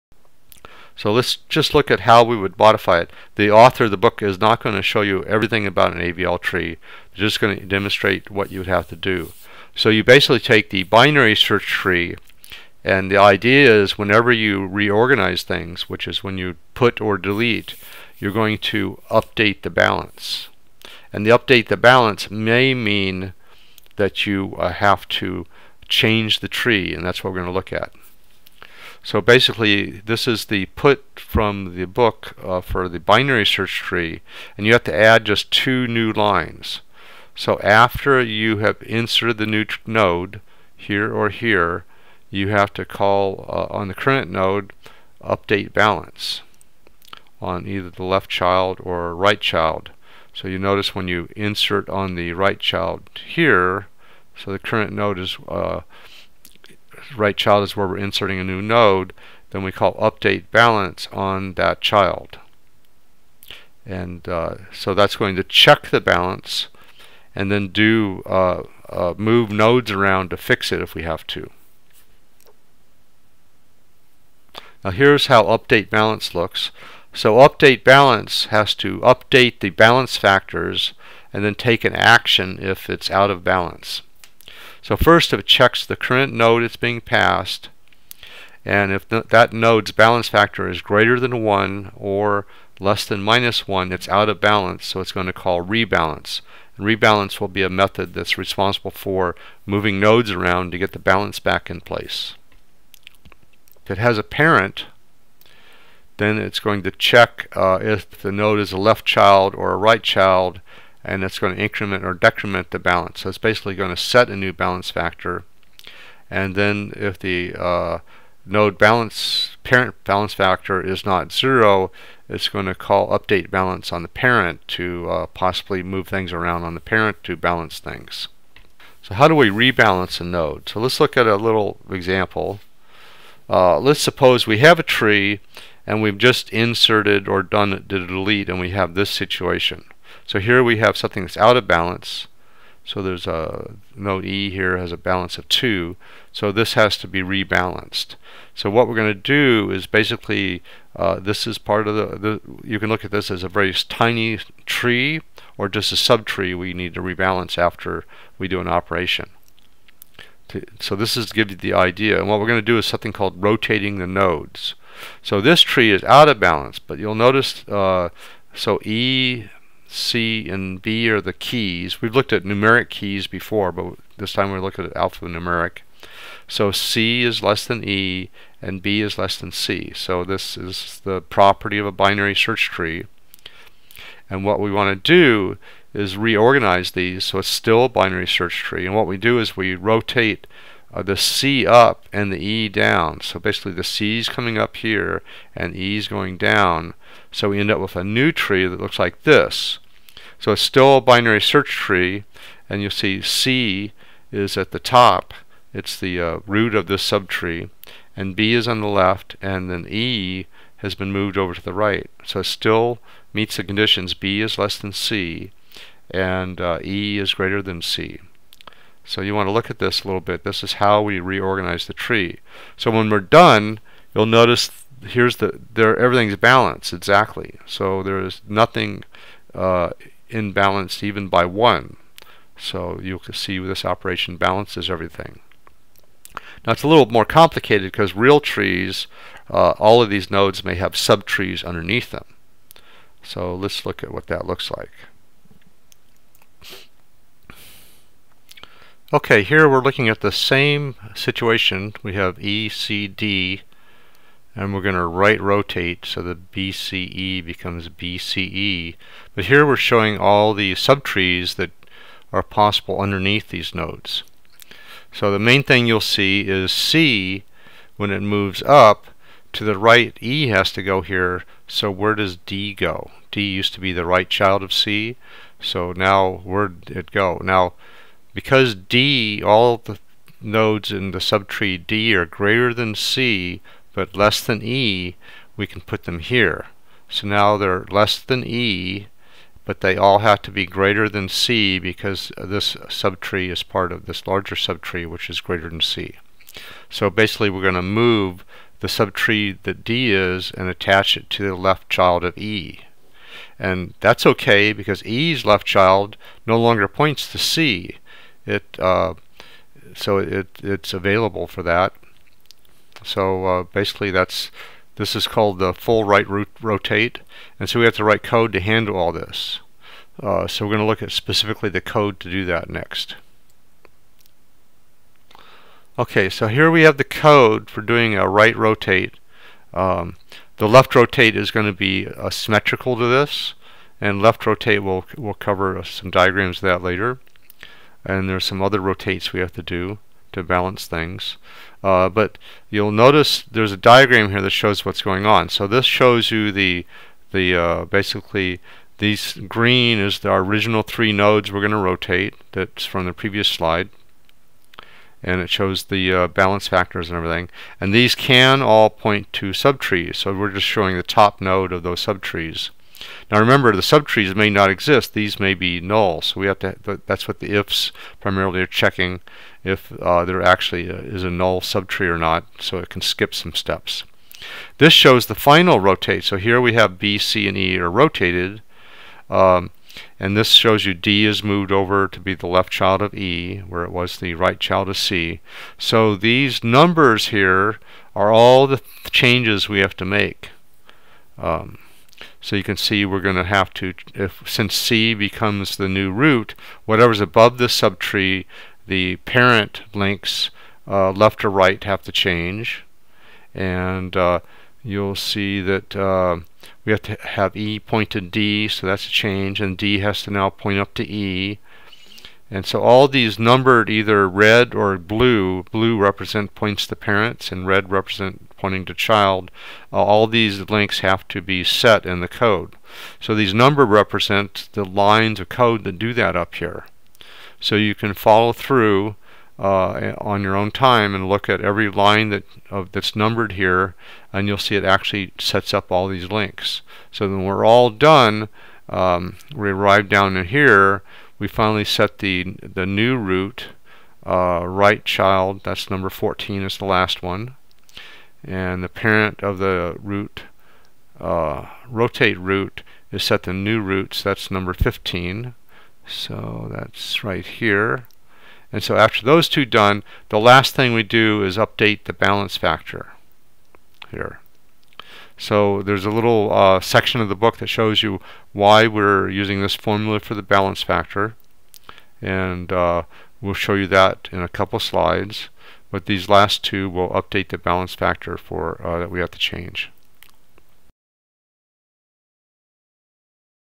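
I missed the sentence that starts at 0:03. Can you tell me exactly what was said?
The author of the book is not going to show you everything about an AVL tree.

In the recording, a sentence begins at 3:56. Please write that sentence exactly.
Now it's a little more complicated because real trees, uh, all of these nodes may have subtrees underneath them.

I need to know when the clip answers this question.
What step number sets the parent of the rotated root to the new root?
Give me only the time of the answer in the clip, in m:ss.
7:34.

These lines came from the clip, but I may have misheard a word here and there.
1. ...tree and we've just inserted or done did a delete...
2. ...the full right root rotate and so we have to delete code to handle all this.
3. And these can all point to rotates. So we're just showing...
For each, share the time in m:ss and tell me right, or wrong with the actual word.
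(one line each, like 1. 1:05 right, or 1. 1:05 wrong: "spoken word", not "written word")
1. 2:14 right
2. 5:15 wrong: "write", not "delete"
3. 5:57 wrong: "subtrees", not "rotates".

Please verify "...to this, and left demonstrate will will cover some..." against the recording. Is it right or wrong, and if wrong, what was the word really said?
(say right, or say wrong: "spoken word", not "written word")
wrong: "rotate", not "demonstrate".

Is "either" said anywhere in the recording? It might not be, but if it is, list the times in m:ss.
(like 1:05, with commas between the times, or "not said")
0:47, 6:53.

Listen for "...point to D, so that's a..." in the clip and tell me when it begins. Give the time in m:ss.
6:47.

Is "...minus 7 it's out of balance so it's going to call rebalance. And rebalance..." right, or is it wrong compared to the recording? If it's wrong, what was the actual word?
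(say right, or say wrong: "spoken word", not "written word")
wrong: "1", not "7".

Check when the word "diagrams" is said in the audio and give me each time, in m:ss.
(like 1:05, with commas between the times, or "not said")
5:36, 5:43.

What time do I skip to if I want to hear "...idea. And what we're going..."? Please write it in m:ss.
2:41.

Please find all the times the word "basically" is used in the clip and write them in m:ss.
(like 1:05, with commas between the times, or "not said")
0:10, 0:29, 1:53, 2:29, 3:13, 4:57, 5:13, 5:47.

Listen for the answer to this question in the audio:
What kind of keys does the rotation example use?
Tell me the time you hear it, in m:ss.
2:54.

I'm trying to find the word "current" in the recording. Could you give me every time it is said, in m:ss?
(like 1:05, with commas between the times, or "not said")
0:43, 0:54, 1:25.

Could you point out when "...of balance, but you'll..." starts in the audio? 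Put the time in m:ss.
2:46.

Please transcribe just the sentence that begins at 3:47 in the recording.
So there is nothing uh, imbalanced even by one.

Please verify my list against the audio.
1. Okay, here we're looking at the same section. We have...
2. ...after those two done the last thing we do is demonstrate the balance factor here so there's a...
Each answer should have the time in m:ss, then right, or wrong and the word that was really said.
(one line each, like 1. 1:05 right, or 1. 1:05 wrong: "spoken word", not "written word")
1. 4:09 wrong: "situation", not "section"
2. 7:38 wrong: "update", not "demonstrate".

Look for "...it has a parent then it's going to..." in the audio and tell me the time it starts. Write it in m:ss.
1:43.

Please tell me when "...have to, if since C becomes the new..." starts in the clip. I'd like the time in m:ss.
6:33.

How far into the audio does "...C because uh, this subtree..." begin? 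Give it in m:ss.
4:51.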